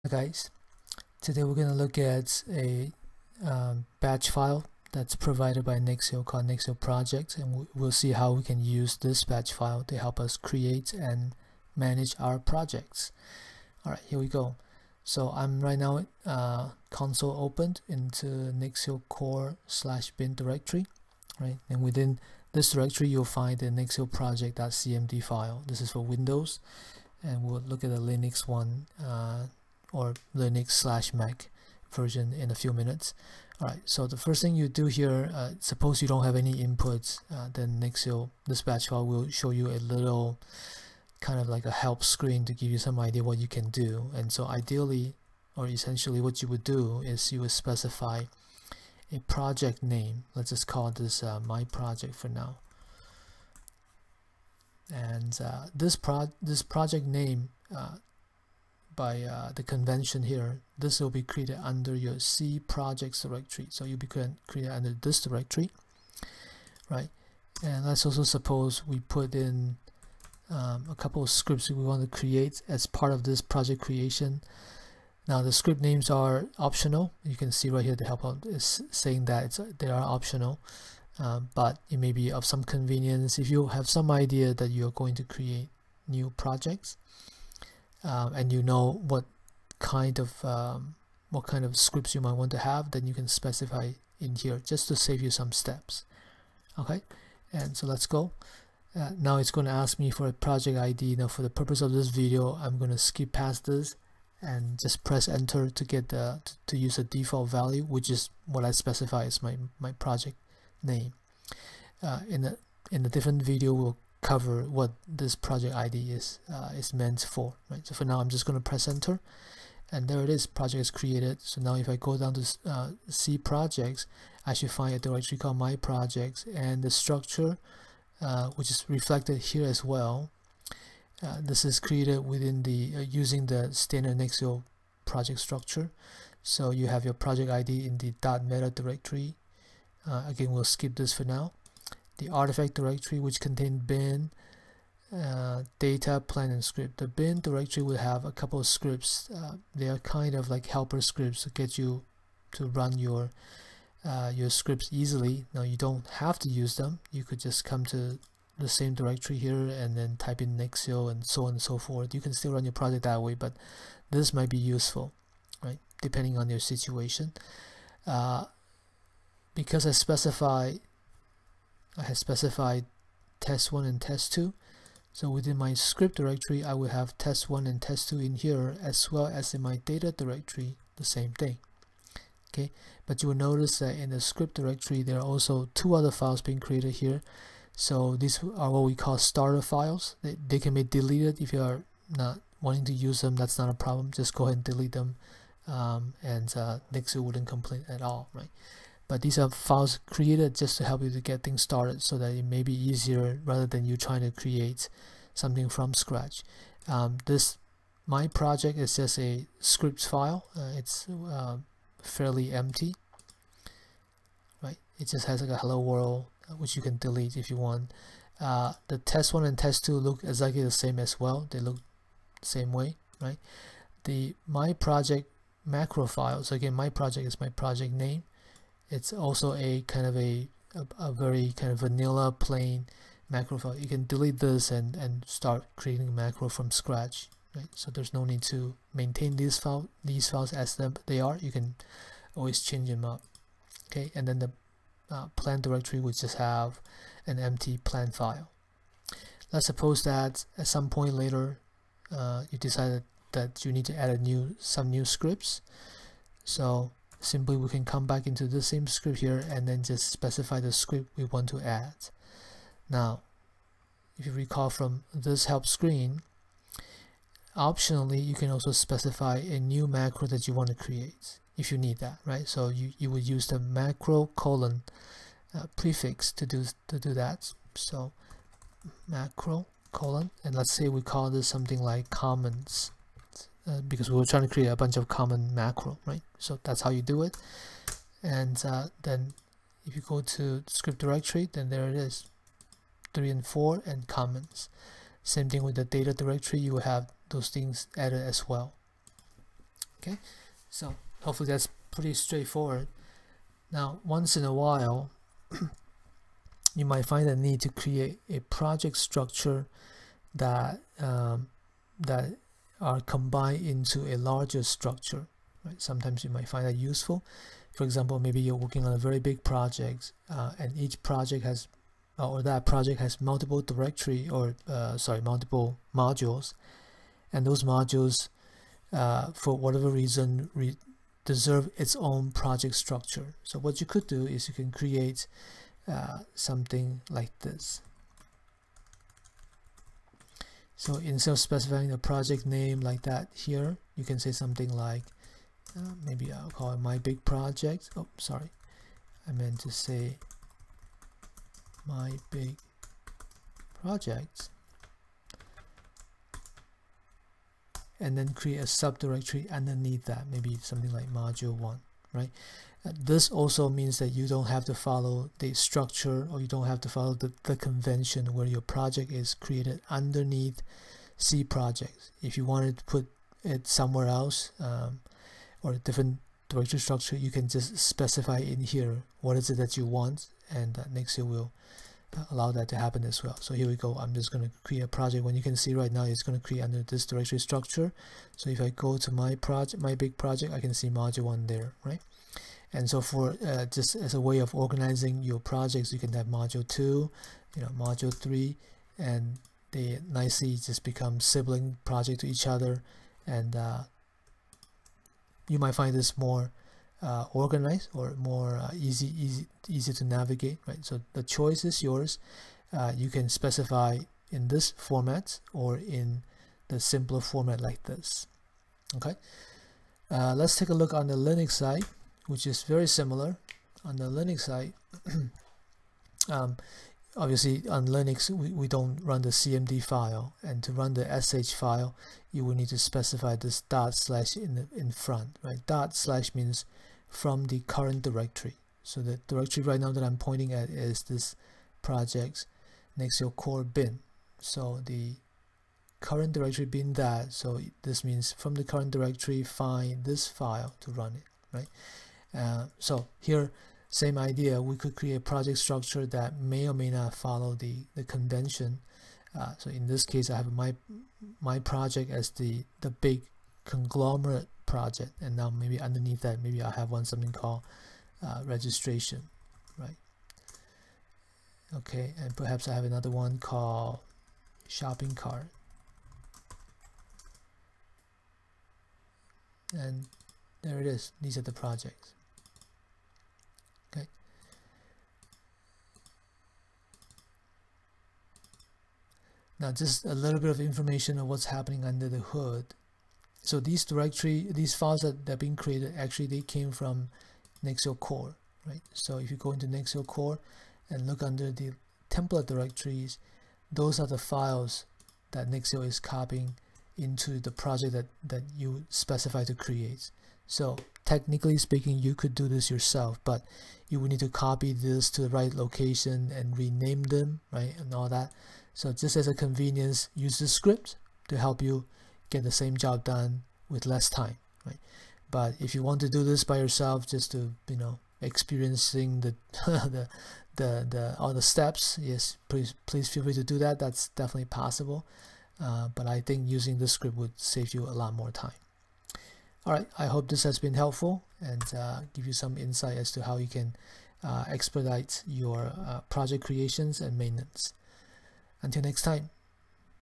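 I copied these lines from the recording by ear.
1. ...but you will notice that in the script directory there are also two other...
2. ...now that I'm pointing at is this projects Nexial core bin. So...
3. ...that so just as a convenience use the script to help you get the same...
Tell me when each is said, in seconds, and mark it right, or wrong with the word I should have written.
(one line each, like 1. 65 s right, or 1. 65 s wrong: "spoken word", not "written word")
1. 183 s right
2. 439 s right
3. 518 s right.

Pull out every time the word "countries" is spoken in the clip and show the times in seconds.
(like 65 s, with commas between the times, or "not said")
not said.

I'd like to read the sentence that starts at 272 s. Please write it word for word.
So you, you would use the macro colon uh, prefix to do, to do that.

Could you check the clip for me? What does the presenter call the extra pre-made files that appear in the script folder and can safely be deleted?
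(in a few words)
starter files.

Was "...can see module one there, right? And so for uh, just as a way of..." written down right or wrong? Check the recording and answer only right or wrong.
right.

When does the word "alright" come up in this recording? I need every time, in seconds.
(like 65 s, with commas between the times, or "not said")
13 s, 33 s.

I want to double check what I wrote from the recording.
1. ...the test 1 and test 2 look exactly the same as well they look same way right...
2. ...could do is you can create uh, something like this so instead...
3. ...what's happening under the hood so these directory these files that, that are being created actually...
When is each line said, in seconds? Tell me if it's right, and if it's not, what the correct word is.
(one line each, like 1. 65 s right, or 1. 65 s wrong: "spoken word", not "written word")
1. 218 s right
2. 333 s right
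3. 491 s right.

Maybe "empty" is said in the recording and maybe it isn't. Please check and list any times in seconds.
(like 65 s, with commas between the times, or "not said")
212 s, 247 s.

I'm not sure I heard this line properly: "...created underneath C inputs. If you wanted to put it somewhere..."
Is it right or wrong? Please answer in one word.
wrong.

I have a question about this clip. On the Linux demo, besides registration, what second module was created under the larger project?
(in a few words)
shopping cart.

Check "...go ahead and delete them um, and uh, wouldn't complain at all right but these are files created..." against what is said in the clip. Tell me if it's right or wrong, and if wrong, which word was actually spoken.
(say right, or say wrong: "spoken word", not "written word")
right.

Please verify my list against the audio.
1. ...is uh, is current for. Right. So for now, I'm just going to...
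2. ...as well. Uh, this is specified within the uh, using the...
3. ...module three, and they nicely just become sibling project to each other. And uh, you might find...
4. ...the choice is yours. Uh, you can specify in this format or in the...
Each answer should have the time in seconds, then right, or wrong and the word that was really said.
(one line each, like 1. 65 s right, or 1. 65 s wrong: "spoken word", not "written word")
1. 116 s wrong: "meant", not "current"
2. 129 s wrong: "created", not "specified"
3. 397 s right
4. 411 s right.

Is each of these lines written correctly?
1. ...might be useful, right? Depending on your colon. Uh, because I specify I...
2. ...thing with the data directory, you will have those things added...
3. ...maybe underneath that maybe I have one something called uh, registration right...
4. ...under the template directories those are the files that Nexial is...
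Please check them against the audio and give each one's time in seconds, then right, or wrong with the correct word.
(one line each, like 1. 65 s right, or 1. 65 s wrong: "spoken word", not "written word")
1. 164 s wrong: "situation", not "colon"
2. 295 s right
3. 465 s right
4. 501 s right.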